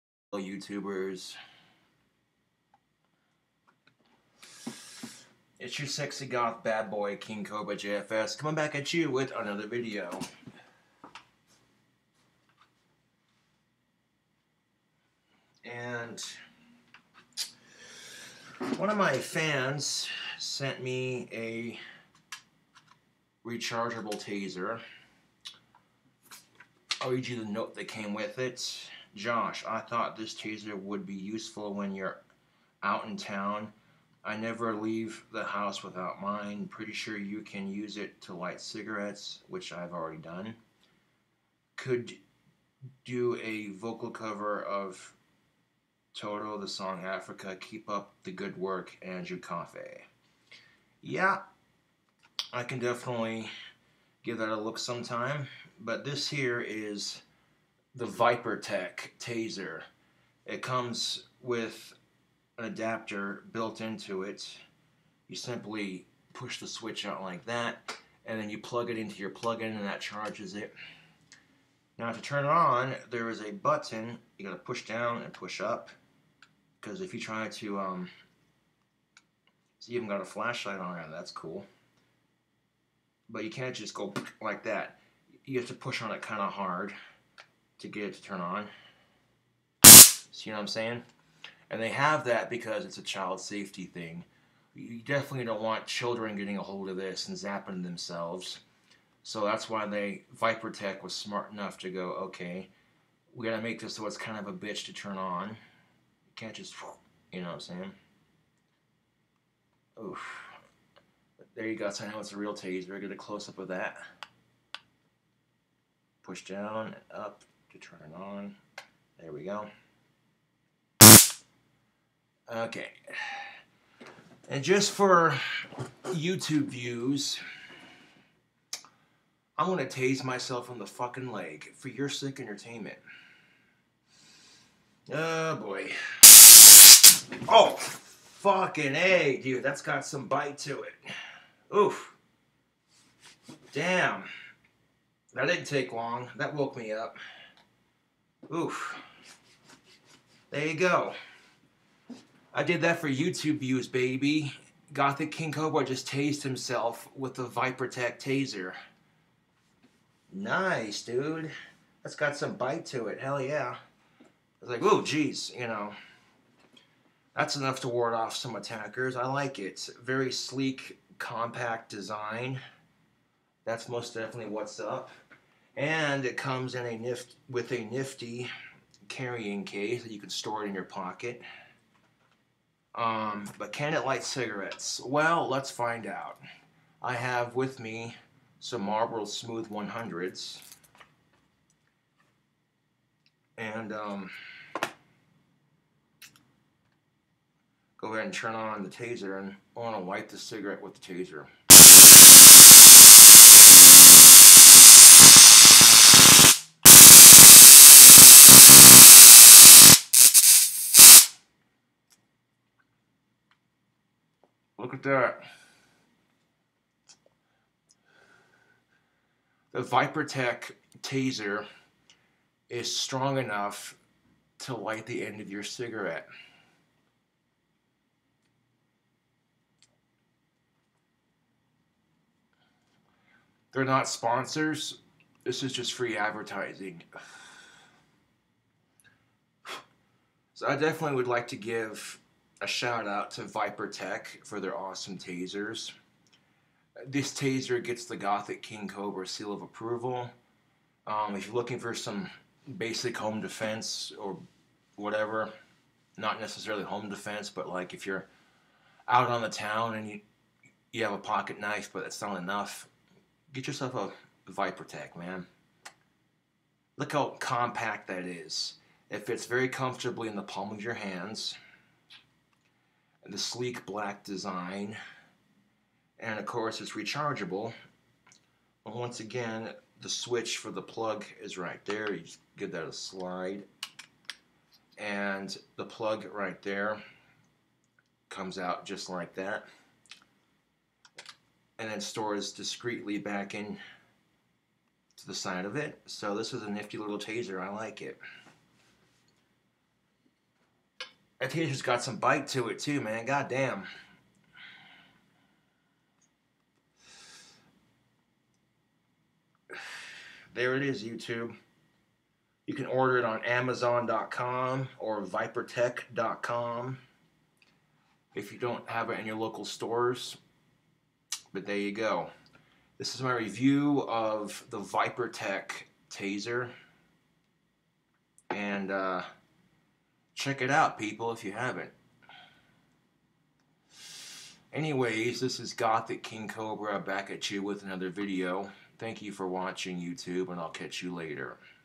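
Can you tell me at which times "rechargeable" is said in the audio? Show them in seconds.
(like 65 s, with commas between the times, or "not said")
23 s, 276 s.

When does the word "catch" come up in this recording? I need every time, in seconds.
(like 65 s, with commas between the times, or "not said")
340 s.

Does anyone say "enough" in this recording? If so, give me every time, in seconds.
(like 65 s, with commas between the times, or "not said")
101 s, 167 s, 223 s, 262 s.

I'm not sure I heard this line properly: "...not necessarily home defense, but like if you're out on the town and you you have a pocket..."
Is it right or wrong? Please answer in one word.
right.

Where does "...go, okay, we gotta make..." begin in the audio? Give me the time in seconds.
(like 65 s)
101 s.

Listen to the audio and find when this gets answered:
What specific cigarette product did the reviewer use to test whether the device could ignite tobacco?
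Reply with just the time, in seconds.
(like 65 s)
188 s.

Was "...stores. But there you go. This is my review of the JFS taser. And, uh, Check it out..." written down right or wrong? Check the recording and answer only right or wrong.
wrong.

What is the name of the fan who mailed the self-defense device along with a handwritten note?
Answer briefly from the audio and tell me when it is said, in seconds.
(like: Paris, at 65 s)
Andrew Cafe, at 49 s.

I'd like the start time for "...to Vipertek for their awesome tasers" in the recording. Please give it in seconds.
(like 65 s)
243 s.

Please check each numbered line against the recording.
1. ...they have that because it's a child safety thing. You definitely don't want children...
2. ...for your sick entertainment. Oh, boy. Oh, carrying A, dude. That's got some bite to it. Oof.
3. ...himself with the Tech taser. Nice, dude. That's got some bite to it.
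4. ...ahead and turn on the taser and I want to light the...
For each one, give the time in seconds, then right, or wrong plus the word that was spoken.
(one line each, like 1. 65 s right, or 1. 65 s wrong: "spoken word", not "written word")
1. 91 s right
2. 131 s wrong: "fucking", not "carrying"
3. 156 s right
4. 198 s right.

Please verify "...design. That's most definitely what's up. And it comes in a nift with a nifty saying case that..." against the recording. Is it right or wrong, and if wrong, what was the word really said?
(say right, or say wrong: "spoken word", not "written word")
wrong: "carrying", not "saying".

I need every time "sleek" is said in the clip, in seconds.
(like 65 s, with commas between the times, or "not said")
170 s, 273 s.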